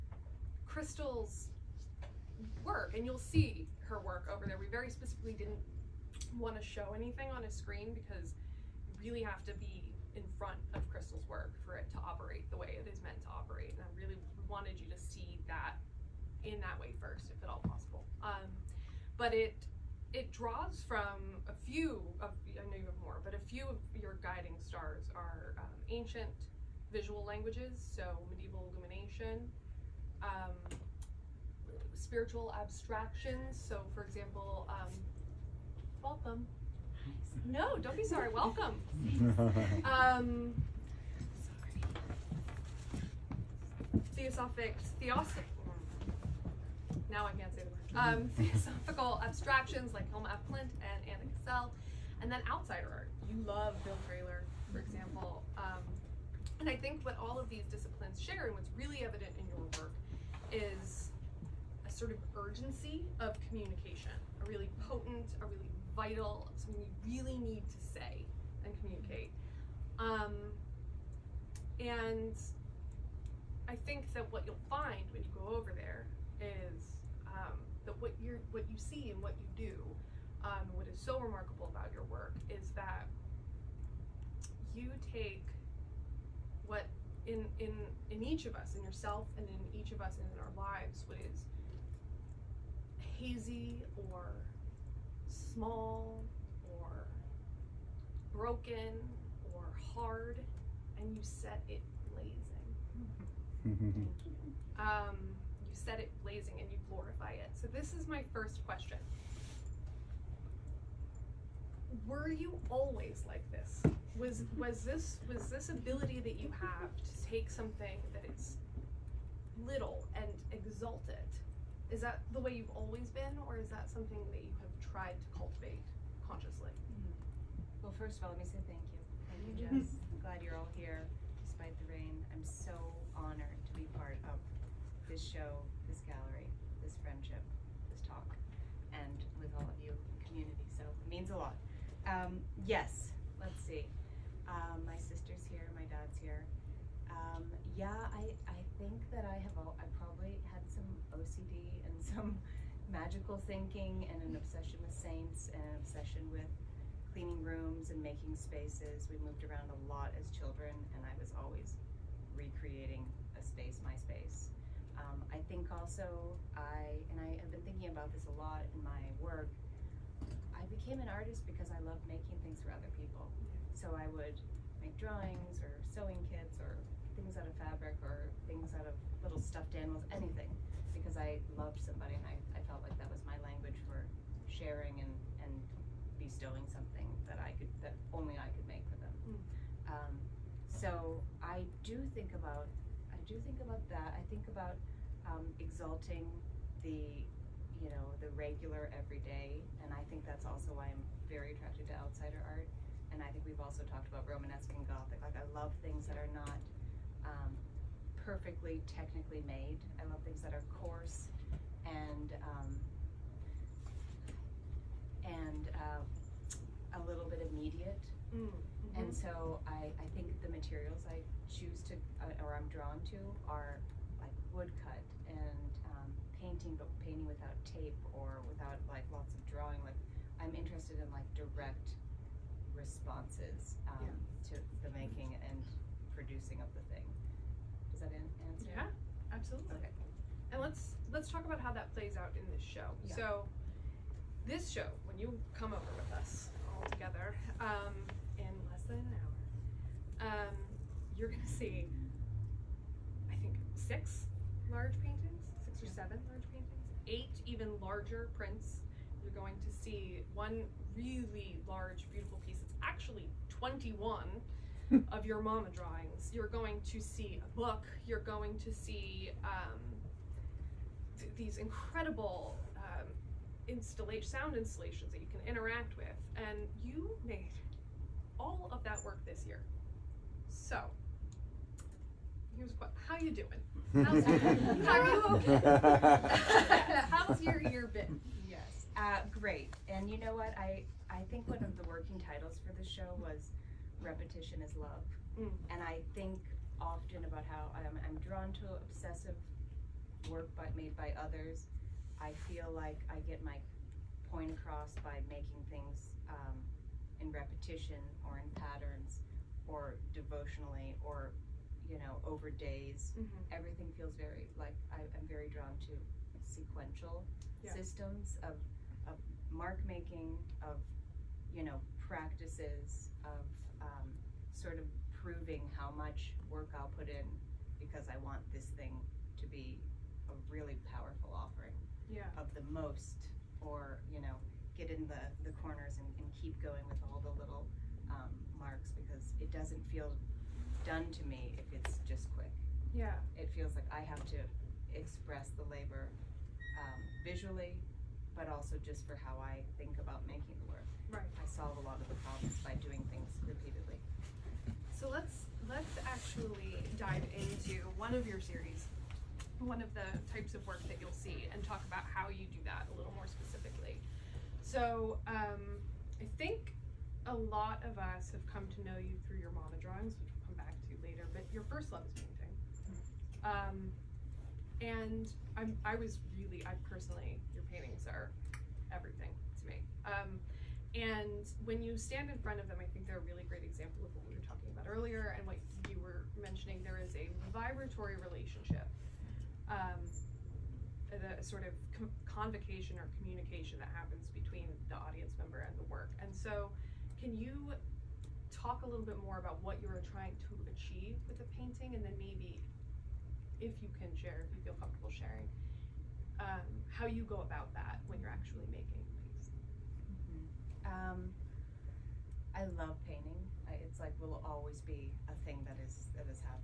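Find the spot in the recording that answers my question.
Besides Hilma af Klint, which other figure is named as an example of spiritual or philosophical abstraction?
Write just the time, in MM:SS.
00:51.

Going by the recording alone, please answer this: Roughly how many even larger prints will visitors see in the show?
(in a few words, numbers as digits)
8.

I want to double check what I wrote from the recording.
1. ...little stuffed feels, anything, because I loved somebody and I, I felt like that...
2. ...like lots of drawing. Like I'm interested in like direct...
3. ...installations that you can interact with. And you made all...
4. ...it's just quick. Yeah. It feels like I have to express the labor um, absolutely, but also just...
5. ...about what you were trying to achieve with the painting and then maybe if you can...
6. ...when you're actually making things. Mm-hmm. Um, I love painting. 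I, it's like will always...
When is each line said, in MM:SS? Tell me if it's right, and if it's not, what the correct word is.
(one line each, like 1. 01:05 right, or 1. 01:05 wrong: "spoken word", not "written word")
1. 02:59 wrong: "animals", not "feels"
2. 03:48 right
3. 04:34 right
4. 05:41 wrong: "visually", not "absolutely"
5. 06:39 right
6. 06:48 right.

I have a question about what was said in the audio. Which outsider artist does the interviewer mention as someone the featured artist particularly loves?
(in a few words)
Bill Traylor.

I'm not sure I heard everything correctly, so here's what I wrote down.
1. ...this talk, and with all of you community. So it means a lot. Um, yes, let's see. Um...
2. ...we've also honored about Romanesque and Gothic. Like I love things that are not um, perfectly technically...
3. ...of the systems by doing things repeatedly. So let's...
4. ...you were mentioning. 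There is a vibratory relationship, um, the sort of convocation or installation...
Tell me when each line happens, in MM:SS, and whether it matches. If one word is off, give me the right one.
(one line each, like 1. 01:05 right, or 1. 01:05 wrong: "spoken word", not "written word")
1. 02:17 right
2. 03:23 wrong: "talked", not "honored"
3. 05:52 wrong: "problems", not "systems"
4. 06:25 wrong: "communication", not "installation".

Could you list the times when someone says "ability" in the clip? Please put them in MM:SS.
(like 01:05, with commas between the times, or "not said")
01:55.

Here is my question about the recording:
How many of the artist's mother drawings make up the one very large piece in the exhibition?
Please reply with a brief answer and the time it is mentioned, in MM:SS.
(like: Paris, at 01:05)
21, at 04:23.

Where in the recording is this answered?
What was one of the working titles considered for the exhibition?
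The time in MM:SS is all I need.
04:54.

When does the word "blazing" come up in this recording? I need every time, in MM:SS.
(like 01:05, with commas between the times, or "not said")
01:42, 01:46.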